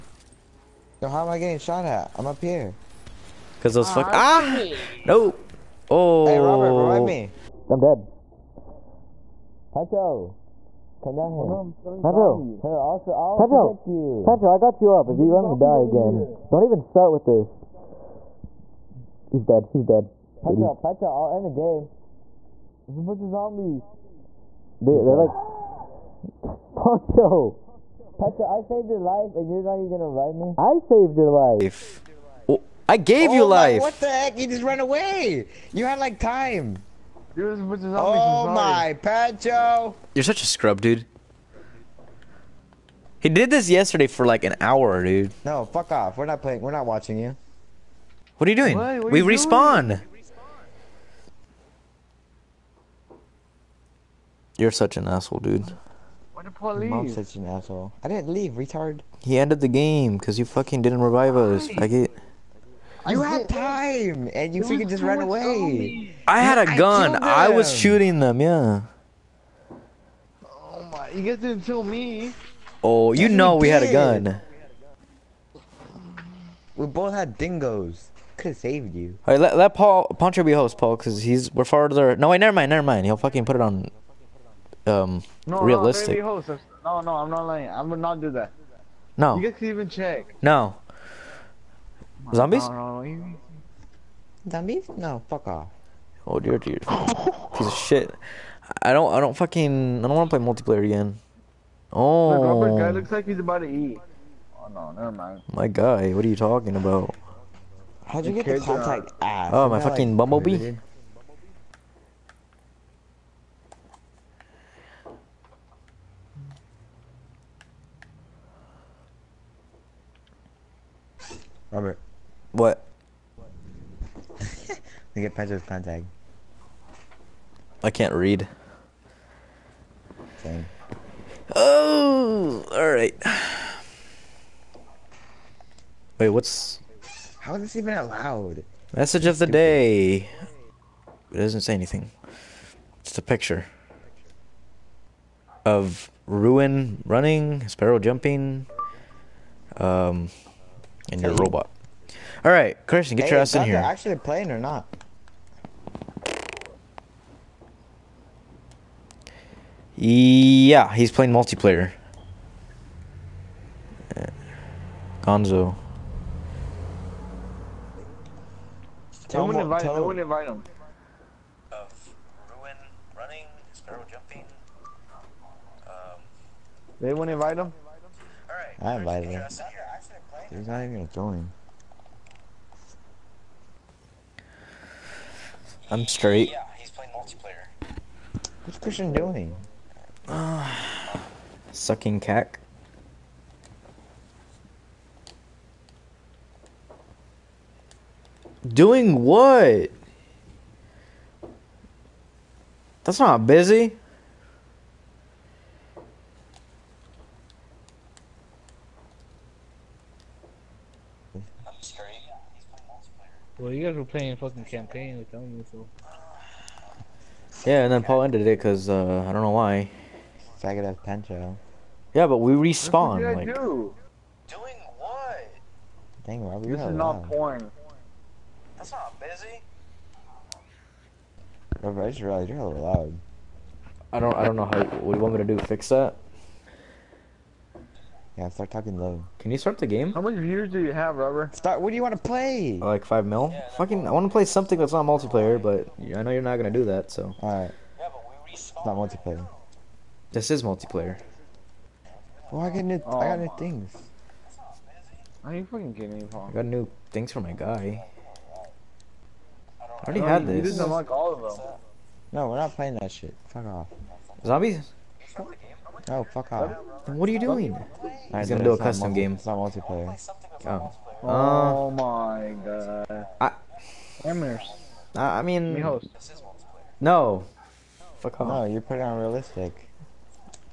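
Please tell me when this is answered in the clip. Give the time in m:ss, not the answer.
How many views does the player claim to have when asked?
4:03.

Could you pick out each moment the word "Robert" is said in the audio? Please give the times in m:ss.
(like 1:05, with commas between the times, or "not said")
0:06, 2:01.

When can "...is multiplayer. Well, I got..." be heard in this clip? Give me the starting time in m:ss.
4:10.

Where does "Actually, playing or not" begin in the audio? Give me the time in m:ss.
2:33.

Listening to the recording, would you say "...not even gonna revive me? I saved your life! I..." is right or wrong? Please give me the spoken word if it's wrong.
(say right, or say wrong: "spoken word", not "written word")
right.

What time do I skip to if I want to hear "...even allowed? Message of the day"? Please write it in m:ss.
2:17.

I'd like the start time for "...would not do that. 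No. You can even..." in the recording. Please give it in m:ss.
1:27.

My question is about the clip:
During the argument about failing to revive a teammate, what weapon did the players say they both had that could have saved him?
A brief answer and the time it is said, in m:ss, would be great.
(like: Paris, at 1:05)
Dingoes, at 1:17.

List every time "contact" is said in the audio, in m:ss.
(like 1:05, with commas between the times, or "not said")
1:48, 2:05.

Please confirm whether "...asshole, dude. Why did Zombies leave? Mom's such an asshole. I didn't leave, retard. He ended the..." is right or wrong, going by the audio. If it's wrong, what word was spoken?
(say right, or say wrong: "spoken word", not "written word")
wrong: "Paul", not "Zombies".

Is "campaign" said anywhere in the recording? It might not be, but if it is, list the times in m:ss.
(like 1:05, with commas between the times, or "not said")
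3:34.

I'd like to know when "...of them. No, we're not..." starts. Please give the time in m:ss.
4:21.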